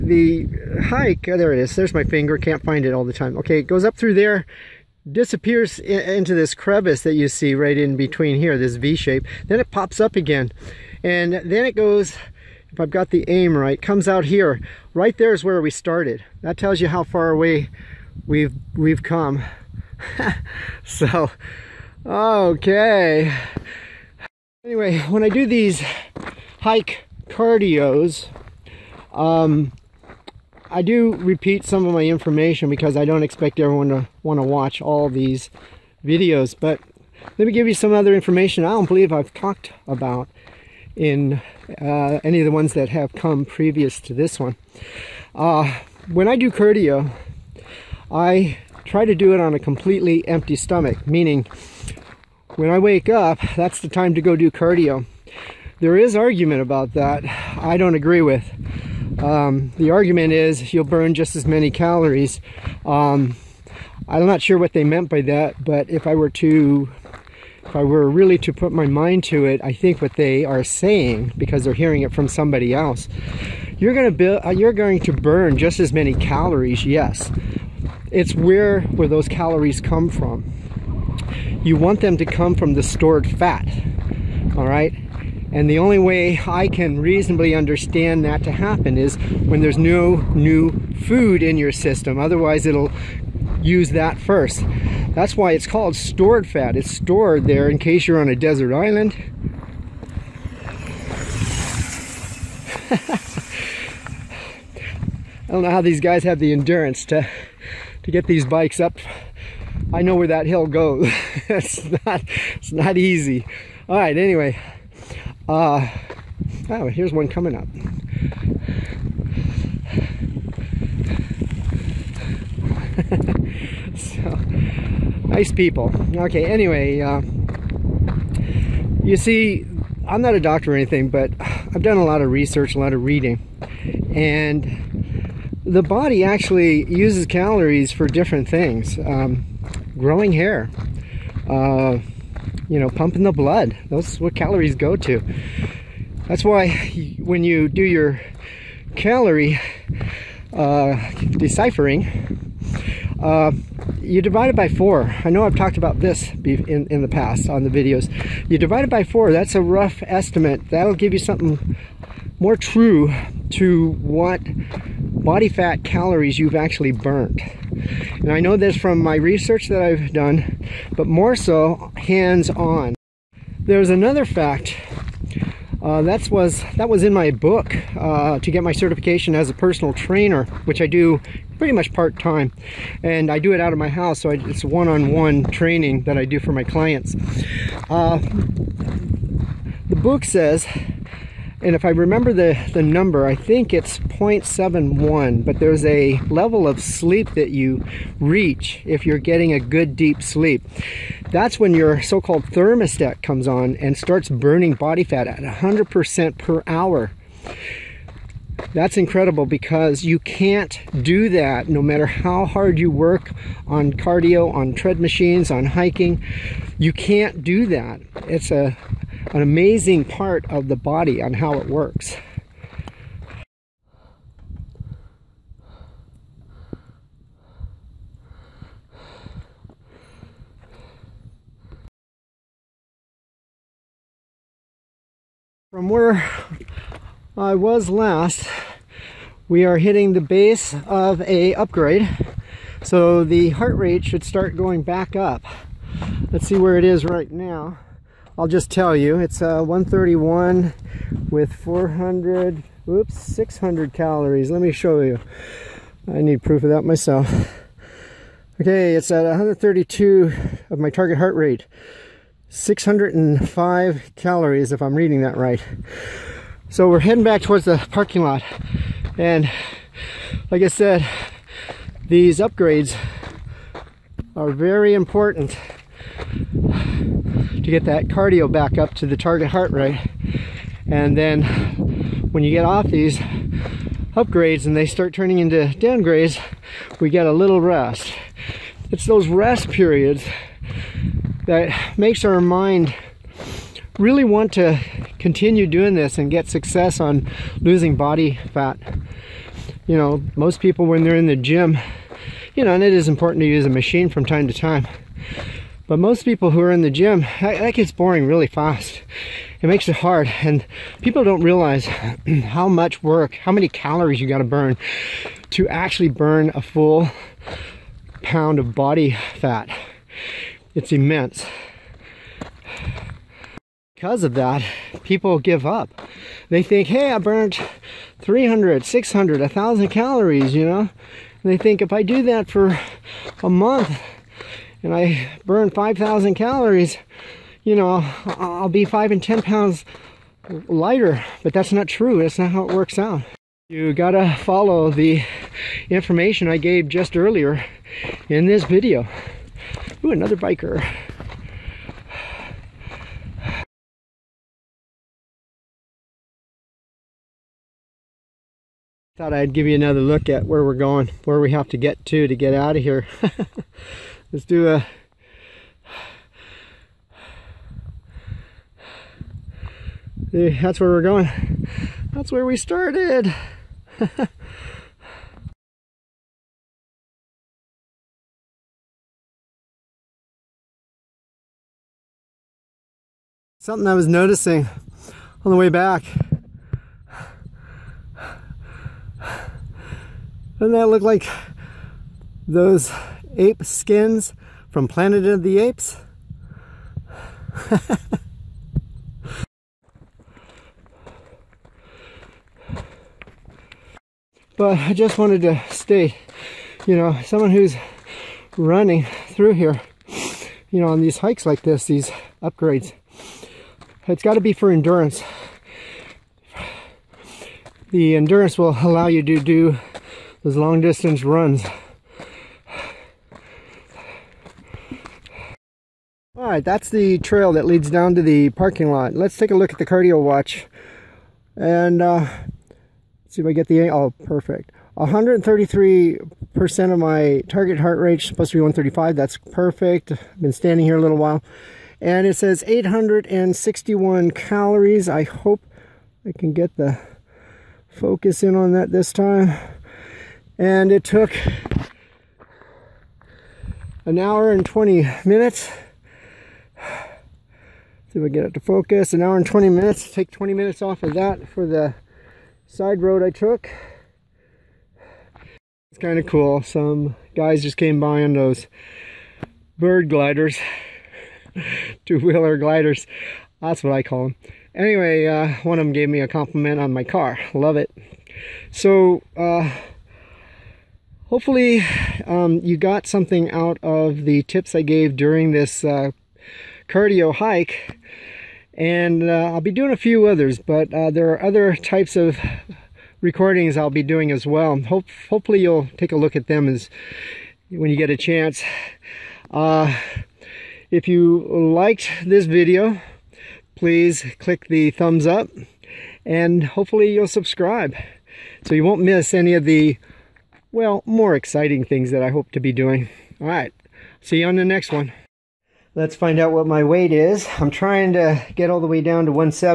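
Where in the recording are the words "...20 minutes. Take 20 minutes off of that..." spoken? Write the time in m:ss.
7:39.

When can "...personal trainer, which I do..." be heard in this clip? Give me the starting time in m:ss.
2:59.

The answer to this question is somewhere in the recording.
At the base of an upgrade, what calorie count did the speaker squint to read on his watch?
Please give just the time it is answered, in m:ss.
4:22.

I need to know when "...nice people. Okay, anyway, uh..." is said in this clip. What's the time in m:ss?
2:05.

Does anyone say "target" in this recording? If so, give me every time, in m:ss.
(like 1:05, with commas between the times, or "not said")
4:20, 4:39, 7:17.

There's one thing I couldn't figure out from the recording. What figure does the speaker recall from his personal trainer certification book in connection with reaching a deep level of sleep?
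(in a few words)
0.71.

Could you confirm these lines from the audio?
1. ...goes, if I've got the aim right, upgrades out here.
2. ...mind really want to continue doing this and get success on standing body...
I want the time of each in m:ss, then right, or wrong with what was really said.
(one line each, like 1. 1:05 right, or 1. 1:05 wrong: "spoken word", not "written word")
1. 0:11 wrong: "comes", not "upgrades"
2. 4:52 wrong: "losing", not "standing".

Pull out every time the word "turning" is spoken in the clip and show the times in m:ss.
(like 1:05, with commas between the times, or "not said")
4:45.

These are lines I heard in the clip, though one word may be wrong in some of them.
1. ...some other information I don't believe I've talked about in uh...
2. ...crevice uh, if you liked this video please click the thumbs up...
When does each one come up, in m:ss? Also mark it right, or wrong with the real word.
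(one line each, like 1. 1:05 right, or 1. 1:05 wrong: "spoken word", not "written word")
1. 0:37 right
2. 8:18 wrong: "chance", not "crevice".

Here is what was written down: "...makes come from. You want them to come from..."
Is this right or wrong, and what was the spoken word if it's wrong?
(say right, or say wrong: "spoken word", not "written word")
wrong: "calories", not "makes".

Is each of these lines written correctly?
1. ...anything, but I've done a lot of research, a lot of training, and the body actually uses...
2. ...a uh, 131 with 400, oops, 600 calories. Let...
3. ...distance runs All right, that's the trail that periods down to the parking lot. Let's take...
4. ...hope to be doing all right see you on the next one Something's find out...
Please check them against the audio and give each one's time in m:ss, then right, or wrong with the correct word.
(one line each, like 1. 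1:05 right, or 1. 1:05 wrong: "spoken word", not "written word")
1. 2:10 wrong: "reading", not "training"
2. 4:09 right
3. 7:00 wrong: "leads", not "periods"
4. 8:32 wrong: "Let", not "Something".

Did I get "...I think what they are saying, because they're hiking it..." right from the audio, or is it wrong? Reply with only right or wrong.
wrong.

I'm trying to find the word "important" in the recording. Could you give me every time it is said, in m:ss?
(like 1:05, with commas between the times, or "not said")
4:34, 5:03.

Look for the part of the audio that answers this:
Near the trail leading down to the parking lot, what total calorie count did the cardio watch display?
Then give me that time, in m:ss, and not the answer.
7:22.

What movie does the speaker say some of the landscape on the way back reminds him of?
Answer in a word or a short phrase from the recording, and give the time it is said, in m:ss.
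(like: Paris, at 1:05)
Planet of the Apes, at 6:34.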